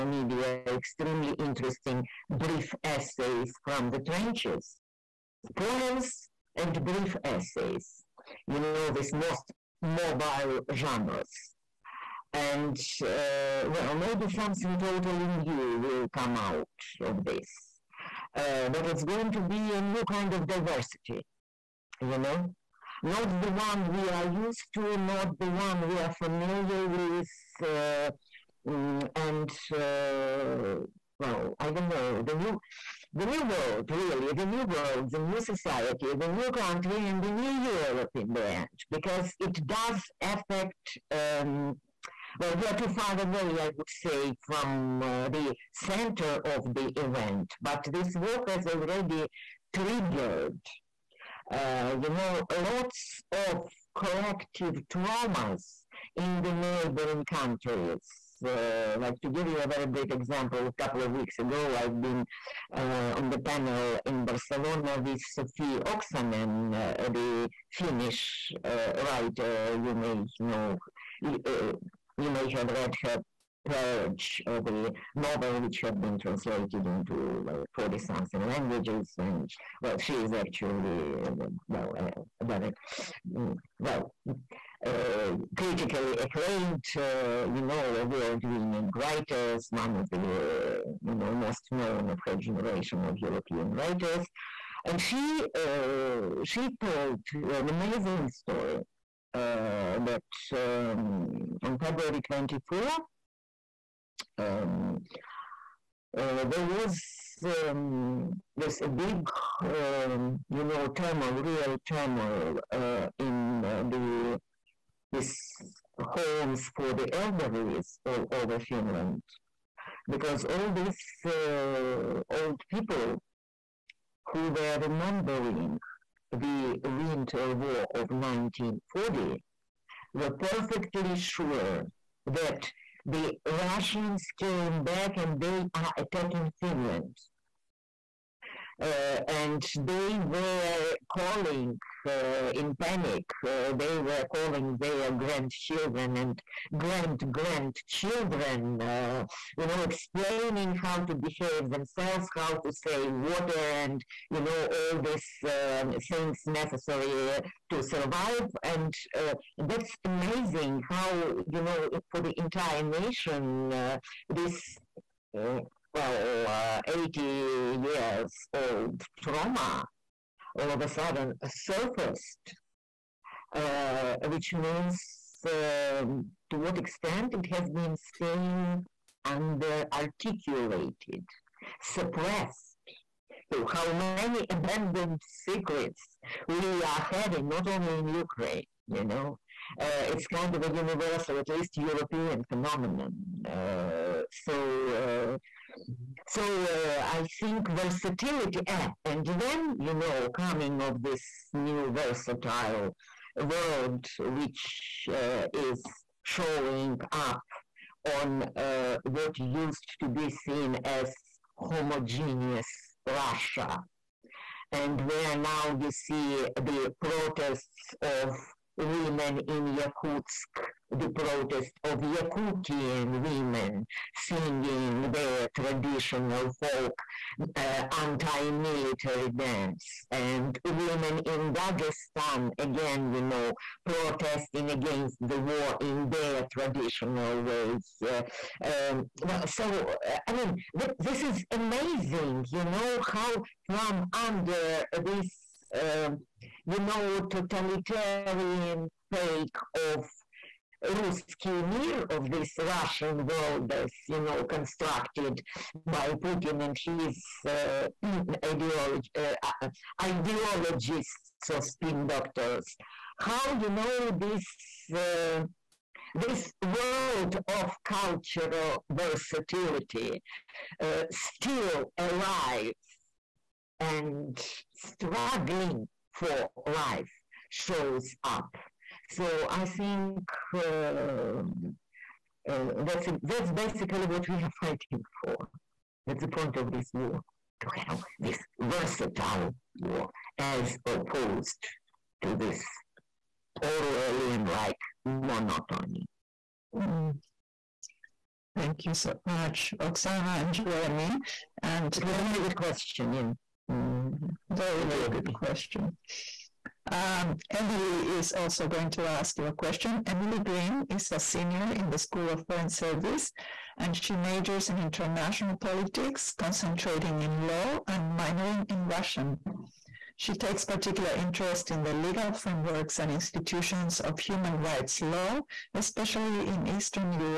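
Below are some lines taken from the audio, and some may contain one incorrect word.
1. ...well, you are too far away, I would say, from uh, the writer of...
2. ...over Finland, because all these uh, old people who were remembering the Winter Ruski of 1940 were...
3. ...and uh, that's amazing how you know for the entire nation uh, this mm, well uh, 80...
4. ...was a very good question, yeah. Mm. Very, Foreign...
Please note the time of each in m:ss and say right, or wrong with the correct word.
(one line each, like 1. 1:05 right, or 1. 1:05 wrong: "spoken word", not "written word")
1. 0:42 wrong: "center", not "writer"
2. 1:58 wrong: "War", not "Ruski"
3. 2:38 right
4. 5:02 wrong: "Thank", not "Foreign".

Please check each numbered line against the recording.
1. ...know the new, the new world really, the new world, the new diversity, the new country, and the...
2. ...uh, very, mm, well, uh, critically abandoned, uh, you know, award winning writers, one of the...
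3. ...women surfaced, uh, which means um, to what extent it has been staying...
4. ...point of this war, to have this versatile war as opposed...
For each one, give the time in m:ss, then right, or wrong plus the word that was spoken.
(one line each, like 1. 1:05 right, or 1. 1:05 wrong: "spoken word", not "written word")
1. 0:31 wrong: "society", not "diversity"
2. 1:21 wrong: "acclaimed", not "abandoned"
3. 2:50 wrong: "sudden", not "women"
4. 4:46 right.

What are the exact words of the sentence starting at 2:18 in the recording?
Uh, and they were calling uh, in panic.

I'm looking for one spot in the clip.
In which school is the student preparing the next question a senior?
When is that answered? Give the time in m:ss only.
5:11.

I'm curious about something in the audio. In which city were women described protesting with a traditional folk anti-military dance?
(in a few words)
Yakutsk.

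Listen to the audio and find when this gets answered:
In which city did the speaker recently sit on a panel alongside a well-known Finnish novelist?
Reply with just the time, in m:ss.
1:04.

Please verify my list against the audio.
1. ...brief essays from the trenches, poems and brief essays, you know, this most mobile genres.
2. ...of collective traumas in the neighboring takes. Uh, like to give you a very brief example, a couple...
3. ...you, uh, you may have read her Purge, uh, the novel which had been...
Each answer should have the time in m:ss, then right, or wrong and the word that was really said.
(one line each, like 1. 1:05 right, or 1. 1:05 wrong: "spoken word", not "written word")
1. 0:02 right
2. 0:53 wrong: "countries", not "takes"
3. 1:11 right.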